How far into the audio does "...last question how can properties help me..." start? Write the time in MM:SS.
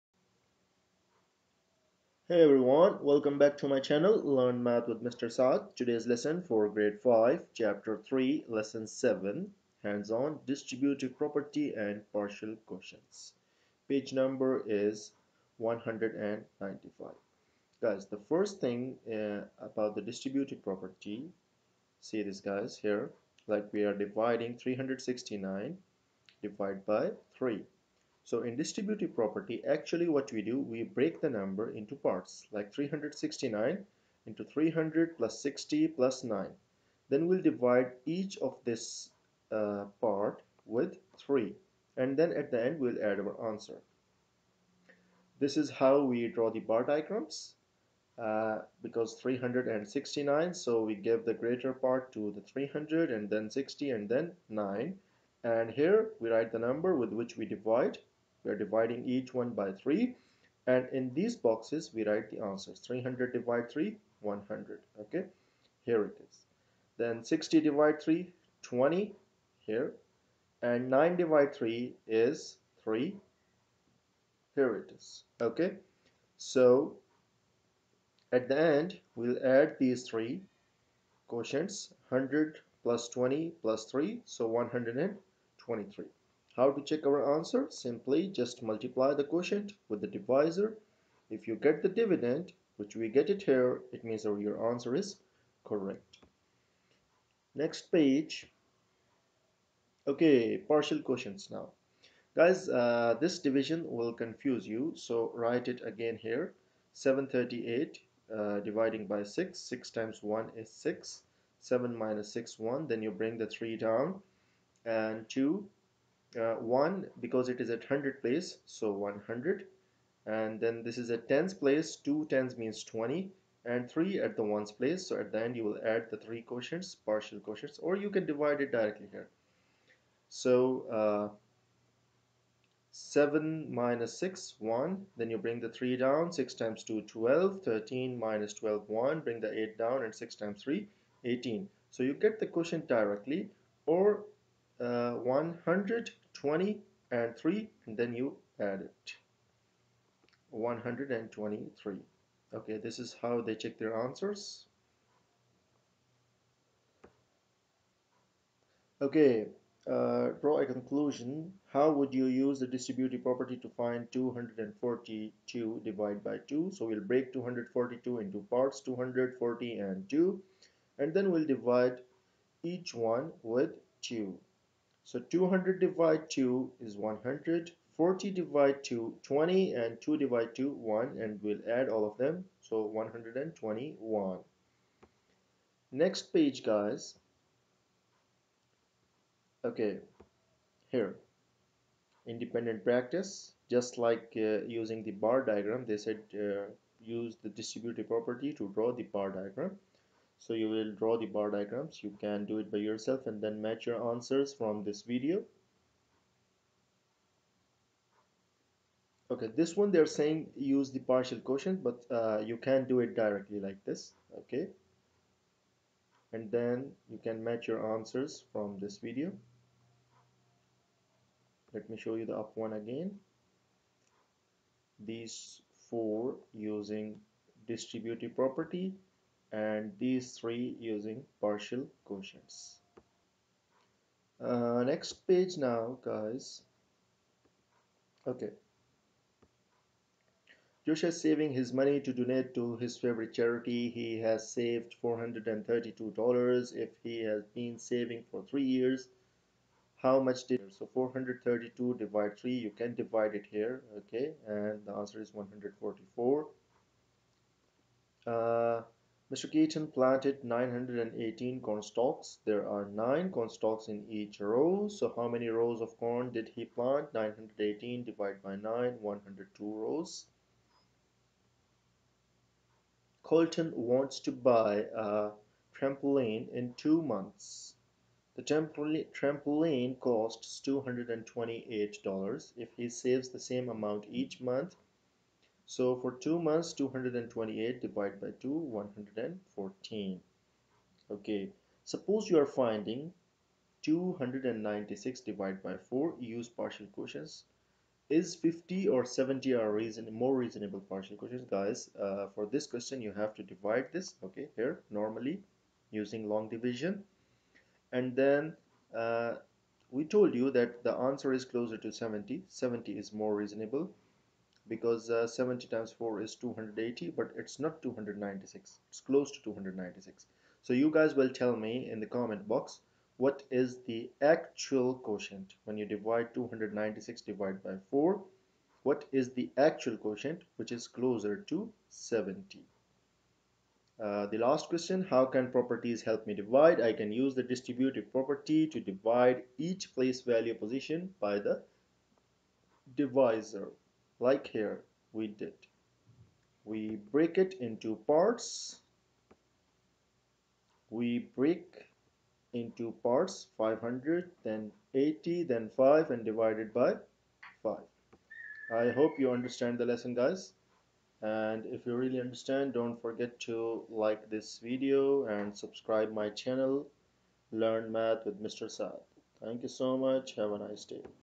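05:34.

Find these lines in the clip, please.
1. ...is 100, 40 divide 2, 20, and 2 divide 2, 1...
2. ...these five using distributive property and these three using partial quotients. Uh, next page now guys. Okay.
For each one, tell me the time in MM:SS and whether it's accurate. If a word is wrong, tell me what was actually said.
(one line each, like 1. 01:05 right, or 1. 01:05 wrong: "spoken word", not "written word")
1. 02:56 right
2. 03:45 wrong: "four", not "five".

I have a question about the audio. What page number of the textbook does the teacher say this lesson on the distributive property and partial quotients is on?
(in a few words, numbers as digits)
195.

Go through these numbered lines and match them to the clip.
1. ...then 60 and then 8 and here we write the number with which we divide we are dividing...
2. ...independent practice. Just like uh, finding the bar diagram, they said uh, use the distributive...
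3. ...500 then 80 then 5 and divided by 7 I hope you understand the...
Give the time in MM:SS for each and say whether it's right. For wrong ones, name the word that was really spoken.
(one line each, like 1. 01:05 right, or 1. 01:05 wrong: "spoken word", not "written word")
1. 00:53 wrong: "9", not "8"
2. 03:12 wrong: "using", not "finding"
3. 05:53 wrong: "5", not "7".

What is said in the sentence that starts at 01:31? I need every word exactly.
If you get the dividend, which we get it here, it means that your answer is correct.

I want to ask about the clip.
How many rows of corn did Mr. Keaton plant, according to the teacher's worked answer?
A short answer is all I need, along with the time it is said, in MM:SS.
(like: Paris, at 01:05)
102 rows, at 04:29.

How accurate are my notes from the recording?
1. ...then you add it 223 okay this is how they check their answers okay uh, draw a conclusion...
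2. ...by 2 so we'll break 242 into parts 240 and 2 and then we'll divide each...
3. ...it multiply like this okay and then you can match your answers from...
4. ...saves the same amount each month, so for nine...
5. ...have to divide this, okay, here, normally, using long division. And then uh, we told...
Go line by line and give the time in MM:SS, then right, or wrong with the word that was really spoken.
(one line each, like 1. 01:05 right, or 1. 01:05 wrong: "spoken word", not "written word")
1. 02:27 wrong: "123", not "223"
2. 02:46 right
3. 03:33 wrong: "directly", not "multiply"
4. 04:42 wrong: "two", not "nine"
5. 05:03 right.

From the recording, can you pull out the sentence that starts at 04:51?
Okay, suppose you are finding 296 divided by 4, use partial quotients.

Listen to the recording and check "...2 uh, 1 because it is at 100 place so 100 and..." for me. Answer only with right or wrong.
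right.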